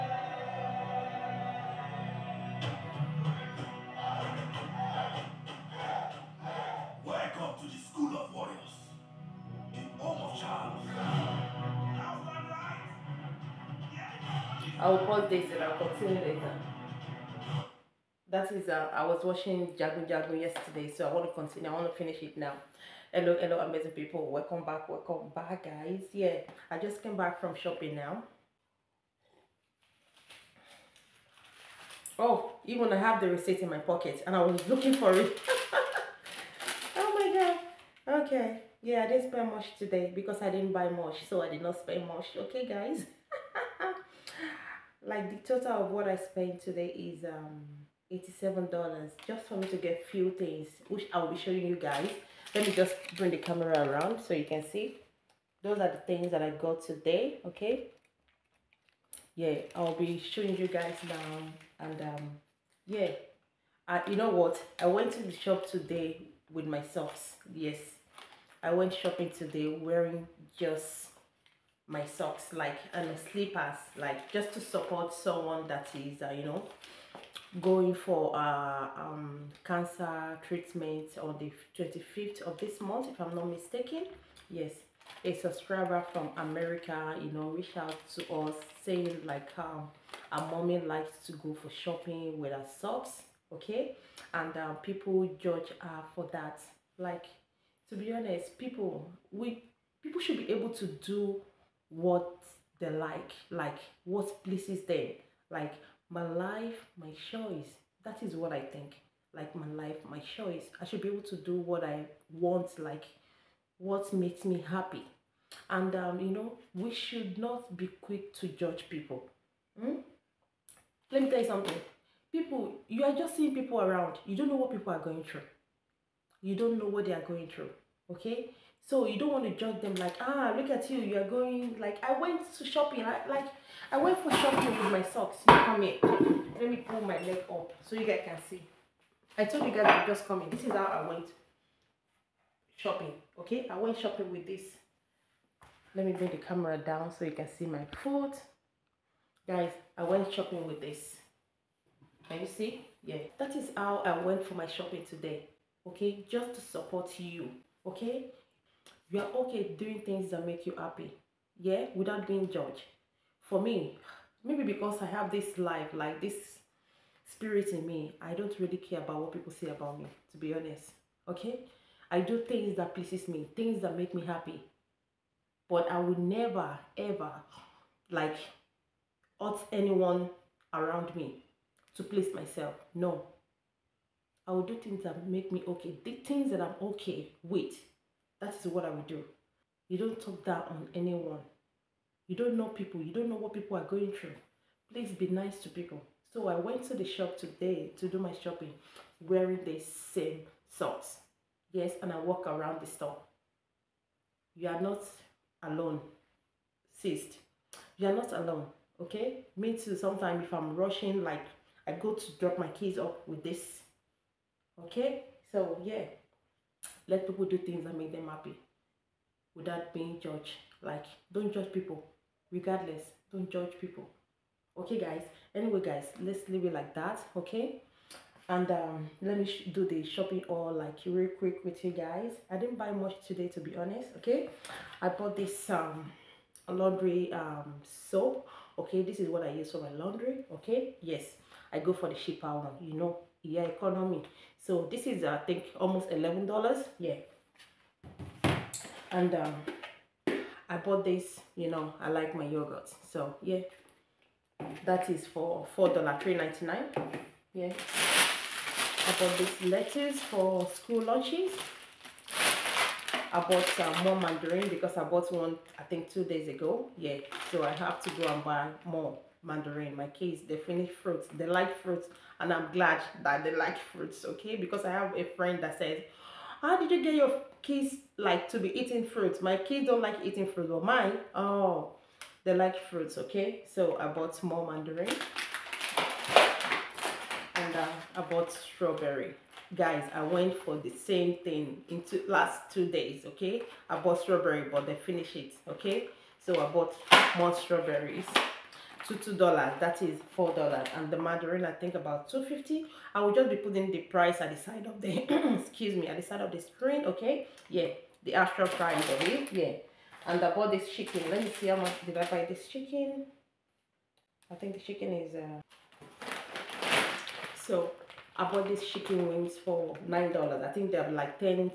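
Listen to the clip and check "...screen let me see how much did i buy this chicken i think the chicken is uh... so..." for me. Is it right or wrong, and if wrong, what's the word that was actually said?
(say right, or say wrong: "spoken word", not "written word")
wrong: "chicken", not "screen".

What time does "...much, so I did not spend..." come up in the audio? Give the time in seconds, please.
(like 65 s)
40 s.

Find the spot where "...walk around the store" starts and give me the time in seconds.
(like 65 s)
202 s.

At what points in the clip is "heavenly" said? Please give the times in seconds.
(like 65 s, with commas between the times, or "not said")
not said.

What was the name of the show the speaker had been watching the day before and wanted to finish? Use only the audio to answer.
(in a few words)
Jagun Jagun.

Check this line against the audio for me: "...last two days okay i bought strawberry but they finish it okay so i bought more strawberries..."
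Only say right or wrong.
right.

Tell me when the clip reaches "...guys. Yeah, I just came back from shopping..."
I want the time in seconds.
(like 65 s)
25 s.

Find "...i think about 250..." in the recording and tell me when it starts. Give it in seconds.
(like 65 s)
301 s.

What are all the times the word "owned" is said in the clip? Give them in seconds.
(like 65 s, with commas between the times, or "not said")
not said.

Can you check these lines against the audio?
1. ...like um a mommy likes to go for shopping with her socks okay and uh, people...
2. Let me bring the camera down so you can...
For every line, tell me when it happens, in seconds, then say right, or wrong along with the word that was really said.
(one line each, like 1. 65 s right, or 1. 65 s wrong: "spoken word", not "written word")
1. 89 s right
2. 145 s right.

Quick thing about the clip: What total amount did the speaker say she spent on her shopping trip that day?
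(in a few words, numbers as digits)
$87.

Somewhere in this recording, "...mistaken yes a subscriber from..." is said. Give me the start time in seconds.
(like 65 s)
83 s.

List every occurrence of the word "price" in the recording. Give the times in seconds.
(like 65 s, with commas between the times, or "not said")
303 s, 308 s.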